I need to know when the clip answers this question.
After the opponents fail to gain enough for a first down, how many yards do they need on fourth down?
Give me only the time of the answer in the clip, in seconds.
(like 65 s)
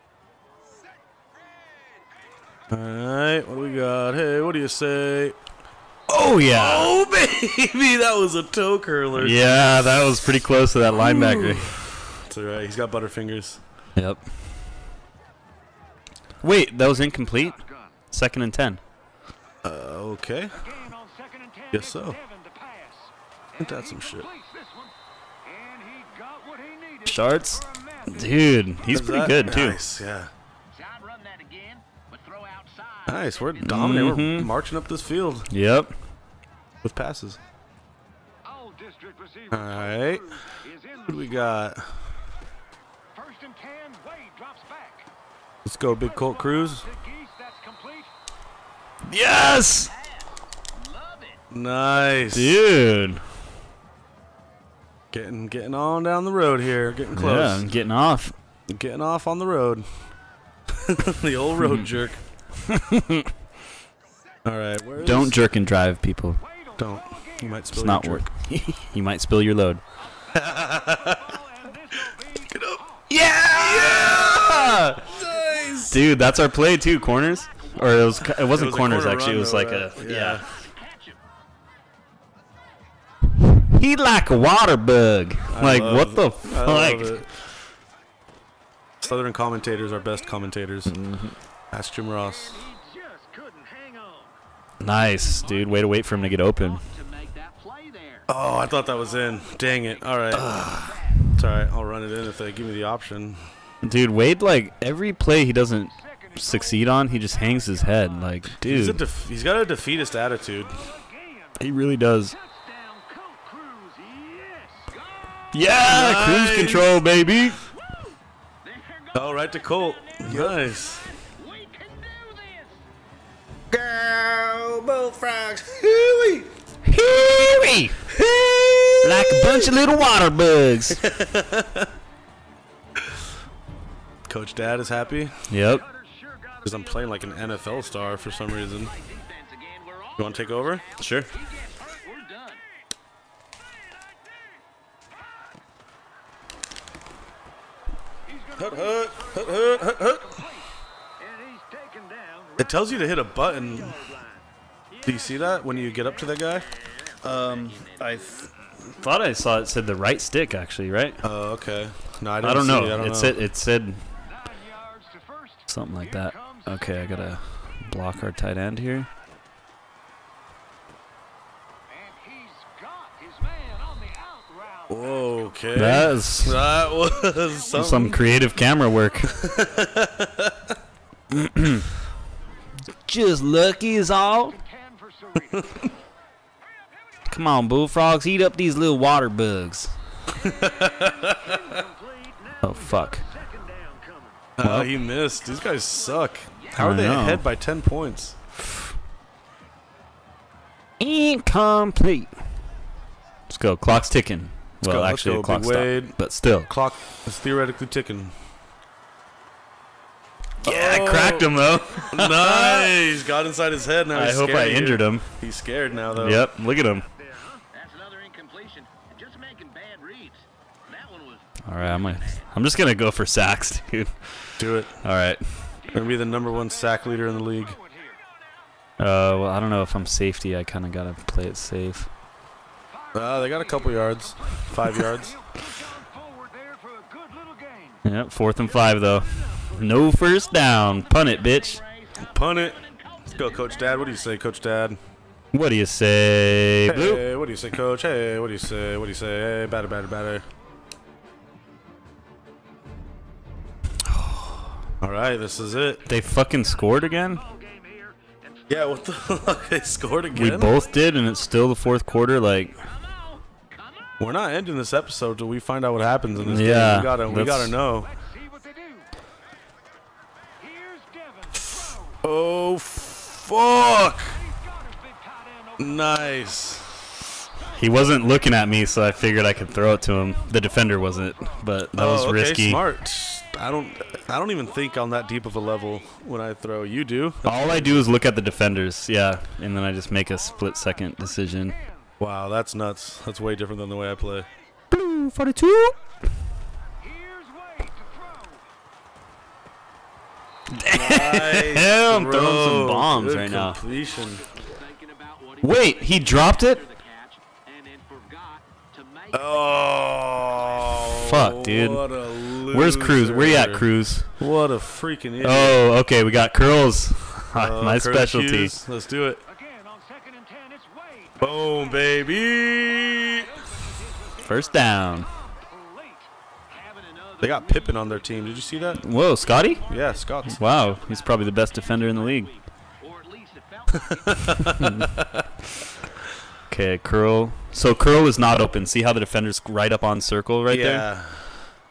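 238 s.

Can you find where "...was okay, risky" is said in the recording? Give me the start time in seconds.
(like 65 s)
282 s.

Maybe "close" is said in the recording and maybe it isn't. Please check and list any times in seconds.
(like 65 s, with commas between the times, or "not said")
10 s, 57 s.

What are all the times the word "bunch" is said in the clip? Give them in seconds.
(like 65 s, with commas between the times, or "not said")
129 s.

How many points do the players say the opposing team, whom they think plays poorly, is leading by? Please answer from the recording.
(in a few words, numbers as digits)
10.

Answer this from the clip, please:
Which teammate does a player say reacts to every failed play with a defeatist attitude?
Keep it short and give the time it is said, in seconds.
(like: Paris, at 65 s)
Wade, at 104 s.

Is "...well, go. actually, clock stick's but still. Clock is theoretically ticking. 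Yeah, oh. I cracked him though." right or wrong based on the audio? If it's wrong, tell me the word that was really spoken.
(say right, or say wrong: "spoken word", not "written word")
wrong: "clock", not "stick".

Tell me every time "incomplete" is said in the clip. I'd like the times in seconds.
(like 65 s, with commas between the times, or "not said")
16 s, 200 s.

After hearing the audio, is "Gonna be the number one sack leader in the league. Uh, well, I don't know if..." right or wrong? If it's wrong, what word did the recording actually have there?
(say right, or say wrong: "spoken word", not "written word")
right.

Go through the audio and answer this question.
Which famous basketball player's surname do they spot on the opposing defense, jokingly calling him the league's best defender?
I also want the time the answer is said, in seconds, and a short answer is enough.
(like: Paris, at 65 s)
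Pippen, at 327 s.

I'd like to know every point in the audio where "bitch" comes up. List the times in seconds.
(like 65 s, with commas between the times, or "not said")
241 s.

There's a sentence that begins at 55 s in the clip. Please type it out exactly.
Getting getting on down the road here.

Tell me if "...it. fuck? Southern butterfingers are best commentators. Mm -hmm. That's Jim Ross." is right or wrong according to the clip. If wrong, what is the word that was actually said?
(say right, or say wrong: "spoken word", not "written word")
wrong: "commentators", not "butterfingers".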